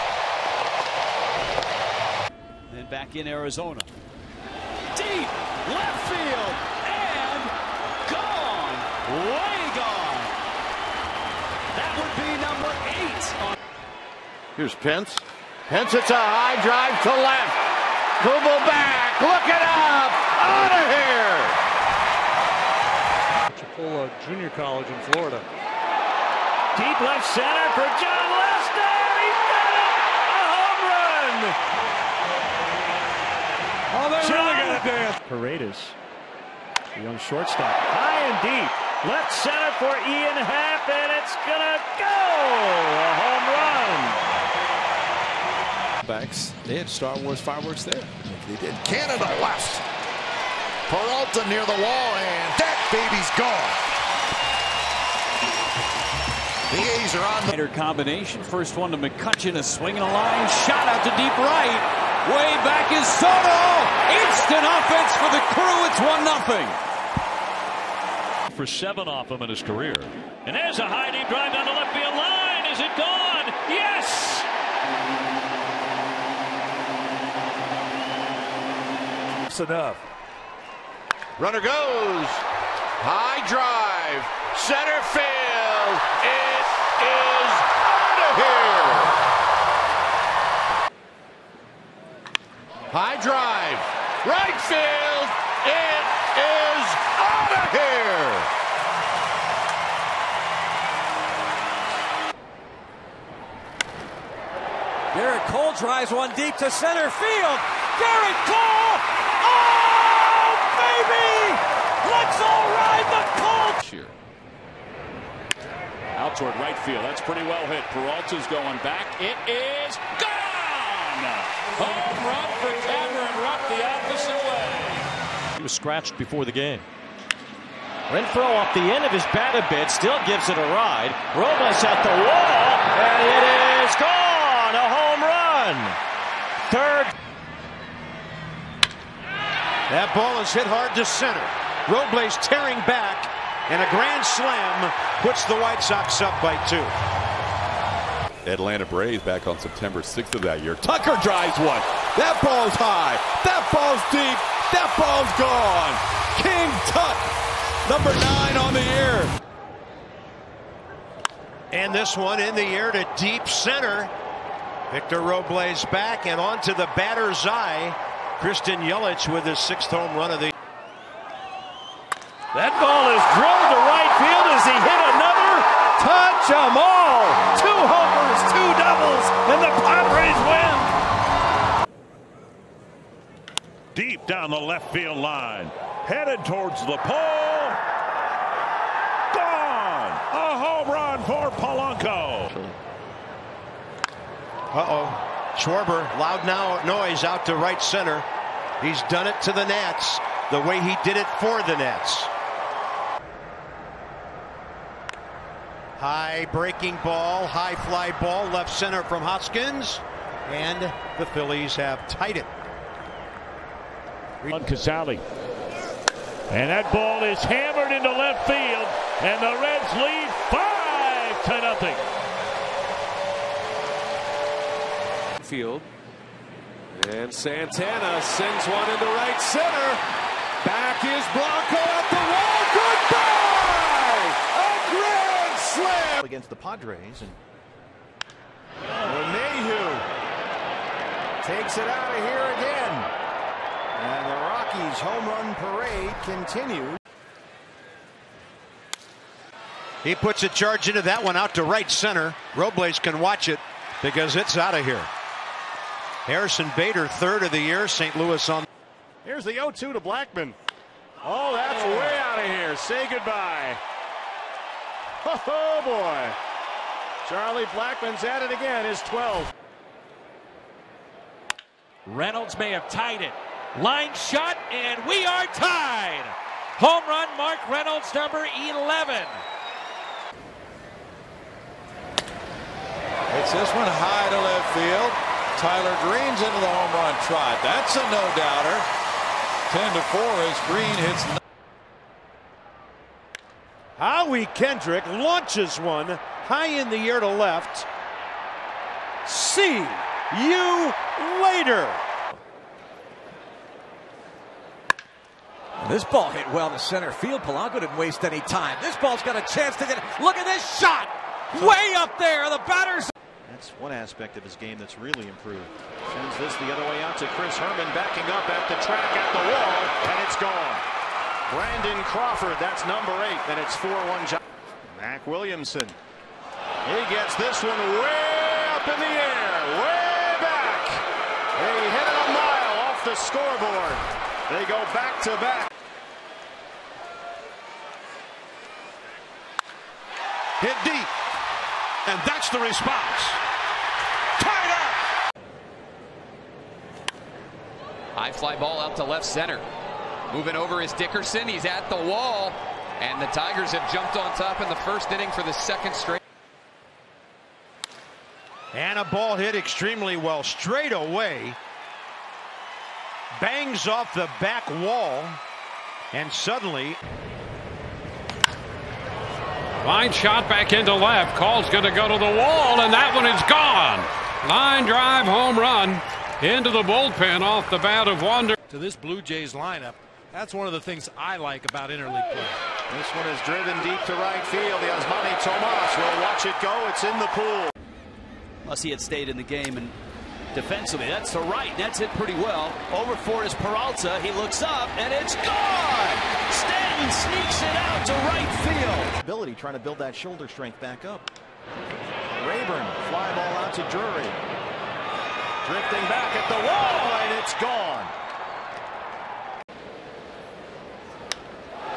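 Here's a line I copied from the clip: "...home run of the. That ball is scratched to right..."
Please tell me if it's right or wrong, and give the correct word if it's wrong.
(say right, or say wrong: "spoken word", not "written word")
wrong: "drilled", not "scratched".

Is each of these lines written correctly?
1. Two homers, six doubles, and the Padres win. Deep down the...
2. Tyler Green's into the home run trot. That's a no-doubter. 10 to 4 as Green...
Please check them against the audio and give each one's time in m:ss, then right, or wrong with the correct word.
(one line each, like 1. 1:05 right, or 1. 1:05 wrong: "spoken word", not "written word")
1. 2:57 wrong: "two", not "six"
2. 4:45 right.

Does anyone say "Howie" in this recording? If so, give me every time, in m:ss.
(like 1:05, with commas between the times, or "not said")
4:53.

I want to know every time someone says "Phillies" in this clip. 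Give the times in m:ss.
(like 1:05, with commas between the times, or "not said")
3:31.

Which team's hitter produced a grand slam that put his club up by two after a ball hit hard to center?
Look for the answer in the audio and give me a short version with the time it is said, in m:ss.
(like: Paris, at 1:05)
White Sox, at 2:25.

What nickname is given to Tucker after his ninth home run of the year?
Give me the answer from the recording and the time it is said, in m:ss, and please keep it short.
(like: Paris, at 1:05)
King Tut, at 2:36.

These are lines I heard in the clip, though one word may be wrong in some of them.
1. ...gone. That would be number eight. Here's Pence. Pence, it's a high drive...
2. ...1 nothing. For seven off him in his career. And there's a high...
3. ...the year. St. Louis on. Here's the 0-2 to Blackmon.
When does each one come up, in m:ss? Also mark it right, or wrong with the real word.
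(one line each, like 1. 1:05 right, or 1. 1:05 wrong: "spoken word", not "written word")
1. 0:09 right
2. 1:06 right
3. 4:17 right.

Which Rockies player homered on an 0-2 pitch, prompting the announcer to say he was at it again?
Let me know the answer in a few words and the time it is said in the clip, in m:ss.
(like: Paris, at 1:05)
Charlie Blackmon, at 4:27.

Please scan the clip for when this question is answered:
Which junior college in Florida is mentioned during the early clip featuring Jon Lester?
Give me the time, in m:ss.
0:23.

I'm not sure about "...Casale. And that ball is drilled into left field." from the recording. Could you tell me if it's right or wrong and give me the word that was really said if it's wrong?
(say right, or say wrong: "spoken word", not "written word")
wrong: "hammered", not "drilled".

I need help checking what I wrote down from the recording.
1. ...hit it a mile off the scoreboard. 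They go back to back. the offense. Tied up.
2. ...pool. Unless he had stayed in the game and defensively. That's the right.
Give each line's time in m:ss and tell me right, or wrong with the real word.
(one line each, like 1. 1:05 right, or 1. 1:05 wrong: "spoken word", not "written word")
1. 5:31 wrong: "response", not "offense"
2. 6:27 right.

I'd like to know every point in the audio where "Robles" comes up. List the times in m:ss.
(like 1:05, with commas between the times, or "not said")
2:11, 2:21, 2:45, 4:12.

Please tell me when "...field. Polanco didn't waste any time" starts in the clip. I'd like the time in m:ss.
5:07.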